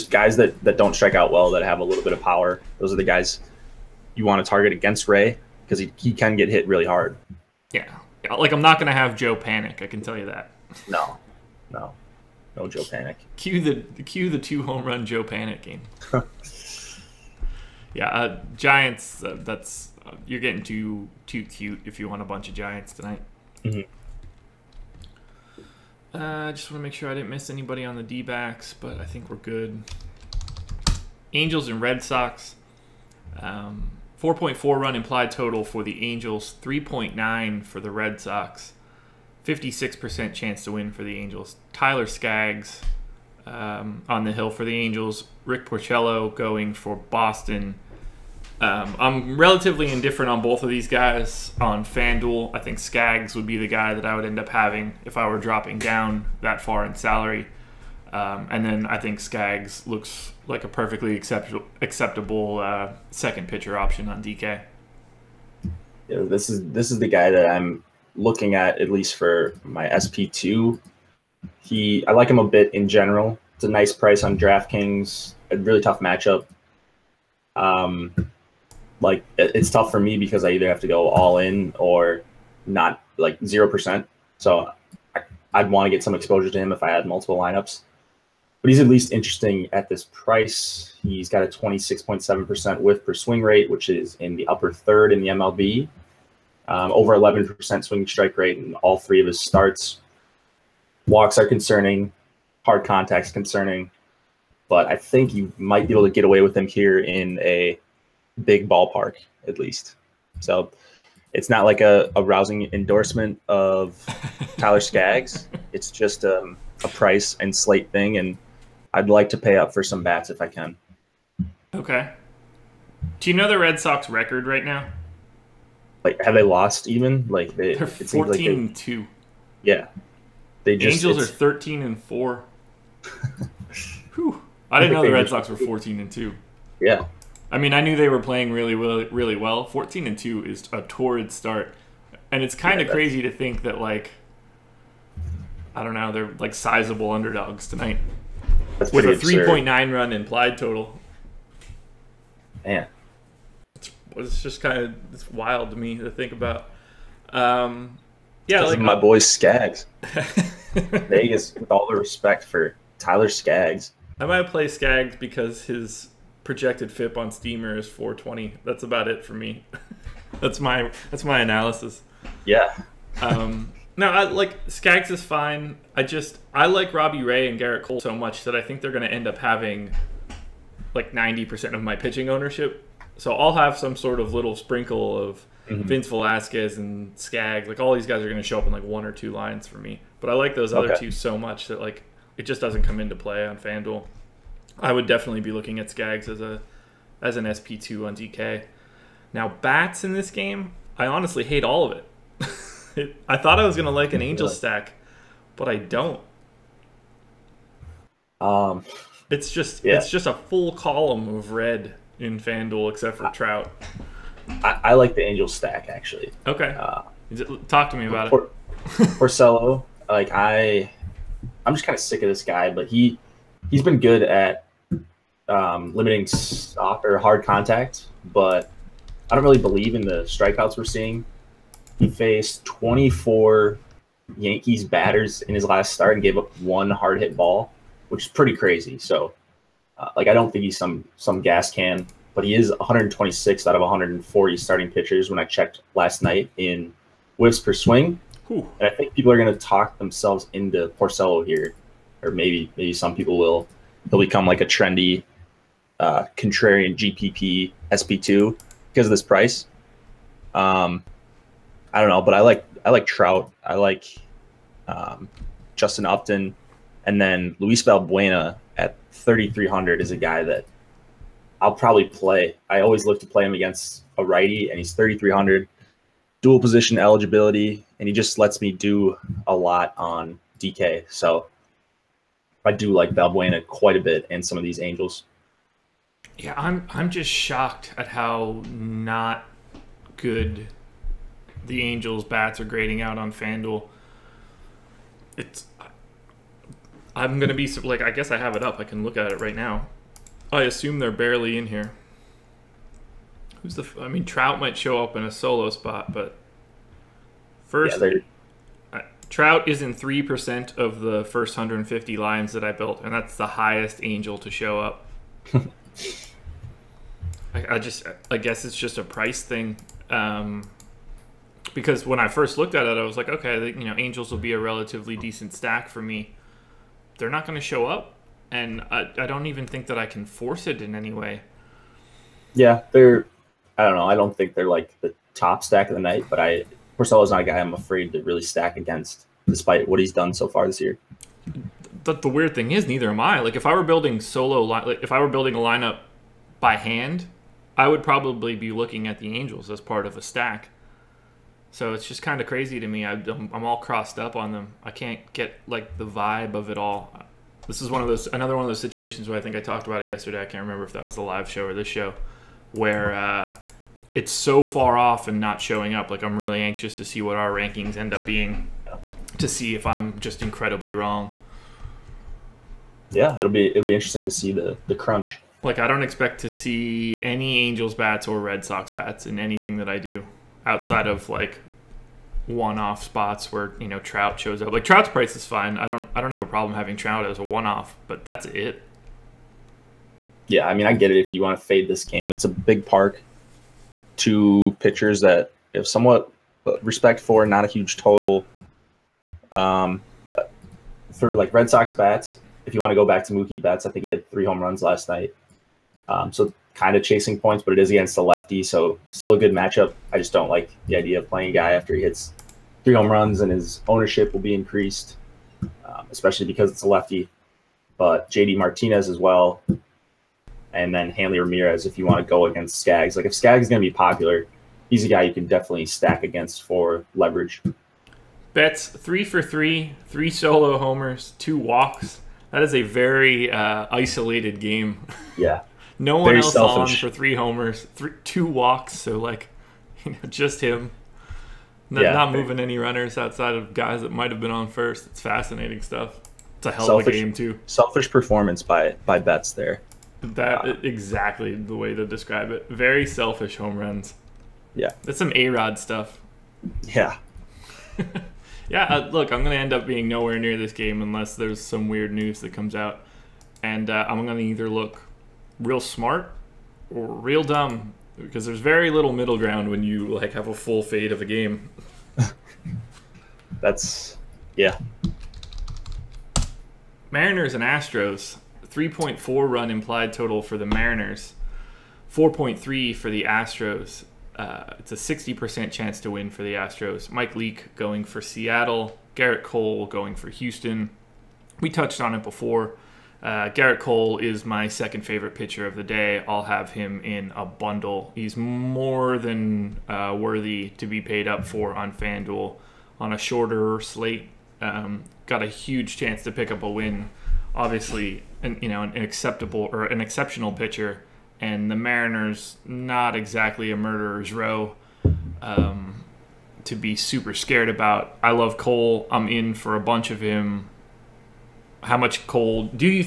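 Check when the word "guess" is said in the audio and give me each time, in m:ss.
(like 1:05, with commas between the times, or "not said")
4:58, 5:18.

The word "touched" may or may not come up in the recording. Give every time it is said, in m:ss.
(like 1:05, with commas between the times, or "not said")
8:11.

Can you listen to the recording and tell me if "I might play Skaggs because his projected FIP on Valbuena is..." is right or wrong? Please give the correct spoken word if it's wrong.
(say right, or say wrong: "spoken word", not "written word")
wrong: "Steamer", not "Valbuena".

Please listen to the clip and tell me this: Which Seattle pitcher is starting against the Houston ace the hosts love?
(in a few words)
Mike Leake.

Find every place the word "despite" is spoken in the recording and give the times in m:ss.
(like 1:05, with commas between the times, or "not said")
5:39.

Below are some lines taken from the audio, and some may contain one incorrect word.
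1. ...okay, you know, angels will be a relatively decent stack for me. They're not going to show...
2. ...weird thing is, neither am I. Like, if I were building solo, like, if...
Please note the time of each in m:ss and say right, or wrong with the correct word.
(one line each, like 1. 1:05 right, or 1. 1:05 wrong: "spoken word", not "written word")
1. 5:23 right
2. 5:42 right.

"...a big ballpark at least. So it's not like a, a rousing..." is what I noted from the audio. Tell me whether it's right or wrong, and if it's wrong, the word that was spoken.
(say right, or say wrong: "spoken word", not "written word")
right.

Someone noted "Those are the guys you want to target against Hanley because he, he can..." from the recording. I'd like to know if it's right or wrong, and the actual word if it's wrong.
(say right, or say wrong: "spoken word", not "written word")
wrong: "Ray", not "Hanley".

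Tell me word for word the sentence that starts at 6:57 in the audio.
But JD Martinez as well, and then Hanley Ramirez if you want to go against Skaggs.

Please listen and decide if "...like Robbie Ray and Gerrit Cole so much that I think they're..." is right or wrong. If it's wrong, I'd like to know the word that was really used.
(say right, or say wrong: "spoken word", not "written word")
right.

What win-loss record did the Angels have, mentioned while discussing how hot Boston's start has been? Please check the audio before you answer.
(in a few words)
13-4.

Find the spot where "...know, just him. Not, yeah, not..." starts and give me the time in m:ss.
7:20.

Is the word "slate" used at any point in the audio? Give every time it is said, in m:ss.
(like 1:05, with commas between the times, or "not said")
1:57, 8:23.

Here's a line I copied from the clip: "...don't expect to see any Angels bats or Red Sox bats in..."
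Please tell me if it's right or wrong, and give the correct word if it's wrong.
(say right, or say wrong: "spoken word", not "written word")
right.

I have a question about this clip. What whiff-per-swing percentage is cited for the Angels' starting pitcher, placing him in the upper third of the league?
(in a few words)
26.7%.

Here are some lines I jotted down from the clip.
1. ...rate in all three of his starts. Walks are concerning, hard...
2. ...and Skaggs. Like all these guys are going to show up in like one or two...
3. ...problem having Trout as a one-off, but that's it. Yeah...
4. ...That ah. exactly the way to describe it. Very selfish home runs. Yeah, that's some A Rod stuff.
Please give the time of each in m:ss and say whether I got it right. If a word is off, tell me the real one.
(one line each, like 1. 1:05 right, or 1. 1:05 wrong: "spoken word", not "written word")
1. 1:38 right
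2. 3:06 right
3. 6:26 right
4. 7:30 right.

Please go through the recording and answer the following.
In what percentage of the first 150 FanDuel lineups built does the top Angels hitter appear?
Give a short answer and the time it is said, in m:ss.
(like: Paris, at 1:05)
3%, at 5:09.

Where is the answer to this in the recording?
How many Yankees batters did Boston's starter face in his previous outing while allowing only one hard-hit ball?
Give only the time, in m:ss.
3:52.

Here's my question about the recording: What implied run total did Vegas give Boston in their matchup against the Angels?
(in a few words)
3.9.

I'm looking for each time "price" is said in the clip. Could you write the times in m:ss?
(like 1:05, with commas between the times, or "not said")
1:13, 1:30, 1:56, 4:19, 5:19, 6:25.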